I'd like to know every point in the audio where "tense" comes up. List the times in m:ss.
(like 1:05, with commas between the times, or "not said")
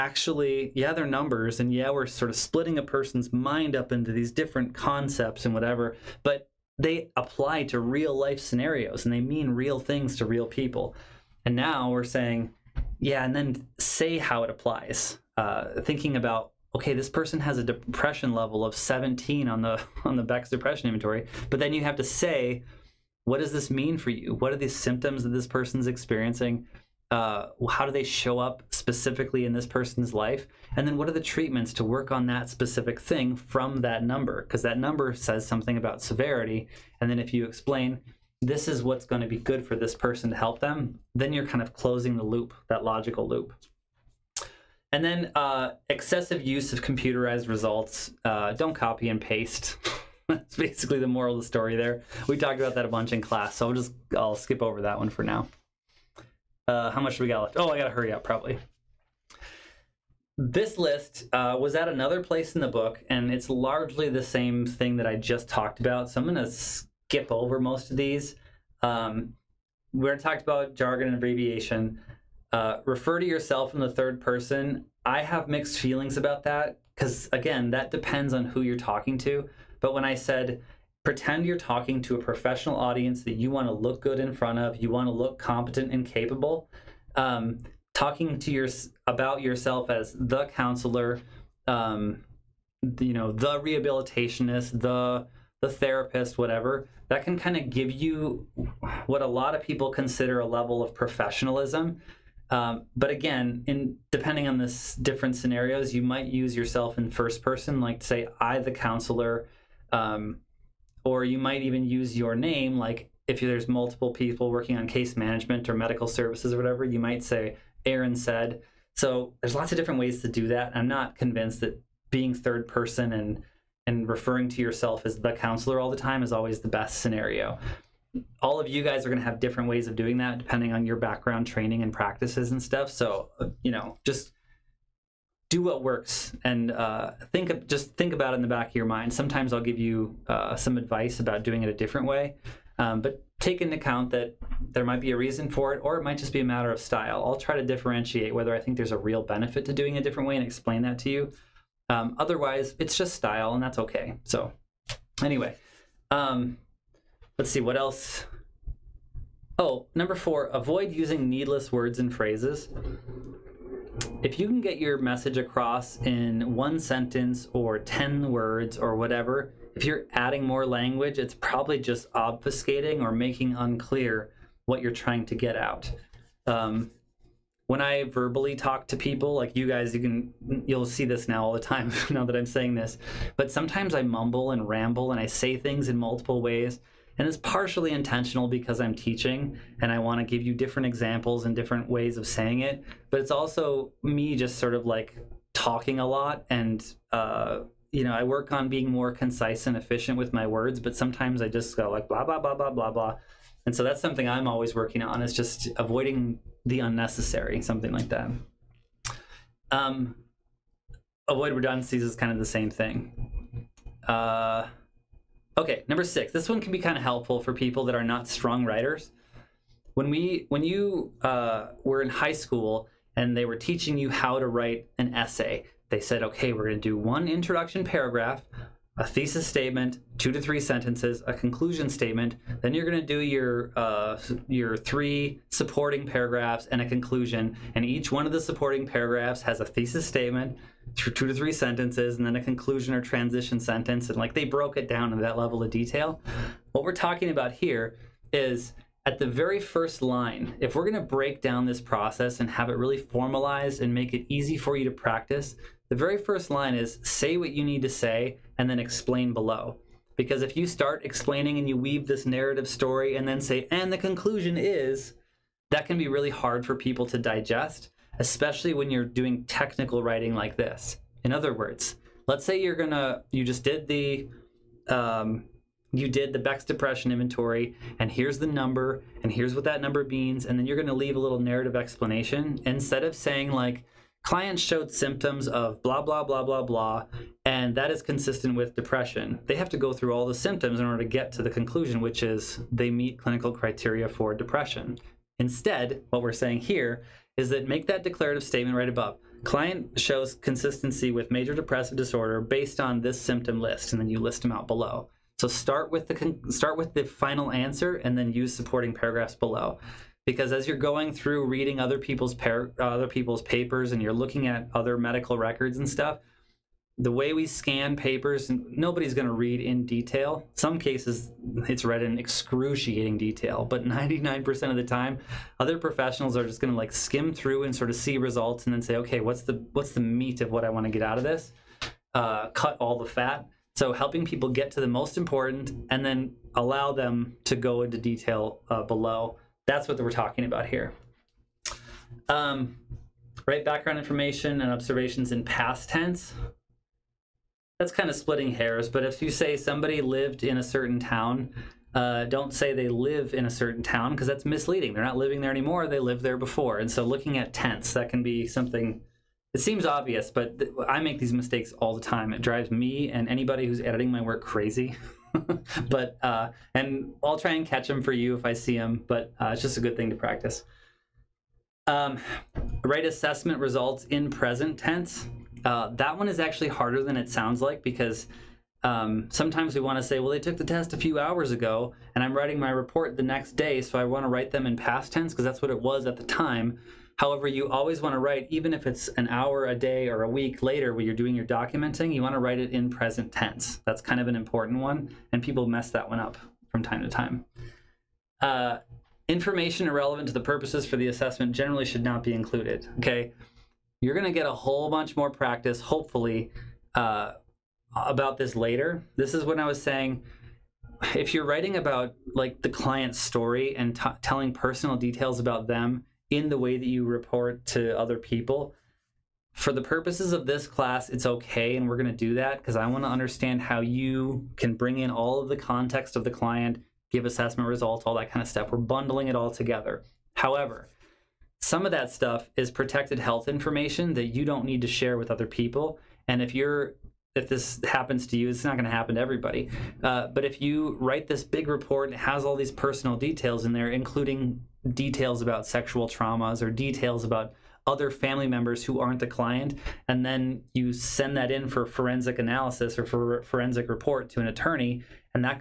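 5:45, 5:57, 6:14, 6:25, 6:33.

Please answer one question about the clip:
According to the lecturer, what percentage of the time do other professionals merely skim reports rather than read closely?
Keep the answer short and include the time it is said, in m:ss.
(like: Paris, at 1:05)
99%, at 5:23.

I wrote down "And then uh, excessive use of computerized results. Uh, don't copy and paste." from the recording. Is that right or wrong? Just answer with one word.
right.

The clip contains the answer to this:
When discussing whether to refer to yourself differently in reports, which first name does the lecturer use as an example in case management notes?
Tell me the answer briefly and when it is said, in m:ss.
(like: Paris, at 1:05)
Aaron, at 1:57.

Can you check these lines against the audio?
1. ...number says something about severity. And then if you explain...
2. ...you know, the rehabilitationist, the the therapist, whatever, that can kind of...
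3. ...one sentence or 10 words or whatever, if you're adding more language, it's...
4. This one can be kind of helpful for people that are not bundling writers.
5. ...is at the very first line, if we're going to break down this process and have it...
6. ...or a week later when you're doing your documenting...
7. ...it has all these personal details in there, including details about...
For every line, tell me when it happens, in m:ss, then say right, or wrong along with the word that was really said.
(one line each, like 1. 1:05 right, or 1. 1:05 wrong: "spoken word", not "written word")
1. 0:34 right
2. 1:32 right
3. 2:46 right
4. 3:36 wrong: "strong", not "bundling"
5. 4:08 right
6. 6:30 right
7. 7:22 right.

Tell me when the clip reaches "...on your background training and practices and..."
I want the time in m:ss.
2:10.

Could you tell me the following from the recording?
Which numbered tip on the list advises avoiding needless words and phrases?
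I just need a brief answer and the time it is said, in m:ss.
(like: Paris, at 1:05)
4, at 2:39.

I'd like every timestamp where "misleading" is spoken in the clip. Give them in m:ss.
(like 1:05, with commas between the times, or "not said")
5:54.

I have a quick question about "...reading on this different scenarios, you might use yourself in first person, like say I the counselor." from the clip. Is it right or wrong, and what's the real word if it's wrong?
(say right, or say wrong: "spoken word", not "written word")
wrong: "depending", not "reading".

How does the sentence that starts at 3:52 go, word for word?
Then you're going to do your uh, your three supporting paragraphs and a conclusion.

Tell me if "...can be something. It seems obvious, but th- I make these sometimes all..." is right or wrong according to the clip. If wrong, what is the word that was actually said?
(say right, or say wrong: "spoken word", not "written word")
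wrong: "mistakes", not "sometimes".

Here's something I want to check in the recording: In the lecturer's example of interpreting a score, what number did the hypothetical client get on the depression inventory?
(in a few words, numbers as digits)
17.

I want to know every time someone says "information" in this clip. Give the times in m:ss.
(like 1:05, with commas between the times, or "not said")
5:43, 6:39, 7:13.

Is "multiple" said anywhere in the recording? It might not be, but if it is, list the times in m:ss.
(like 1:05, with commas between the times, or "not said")
1:53, 3:05.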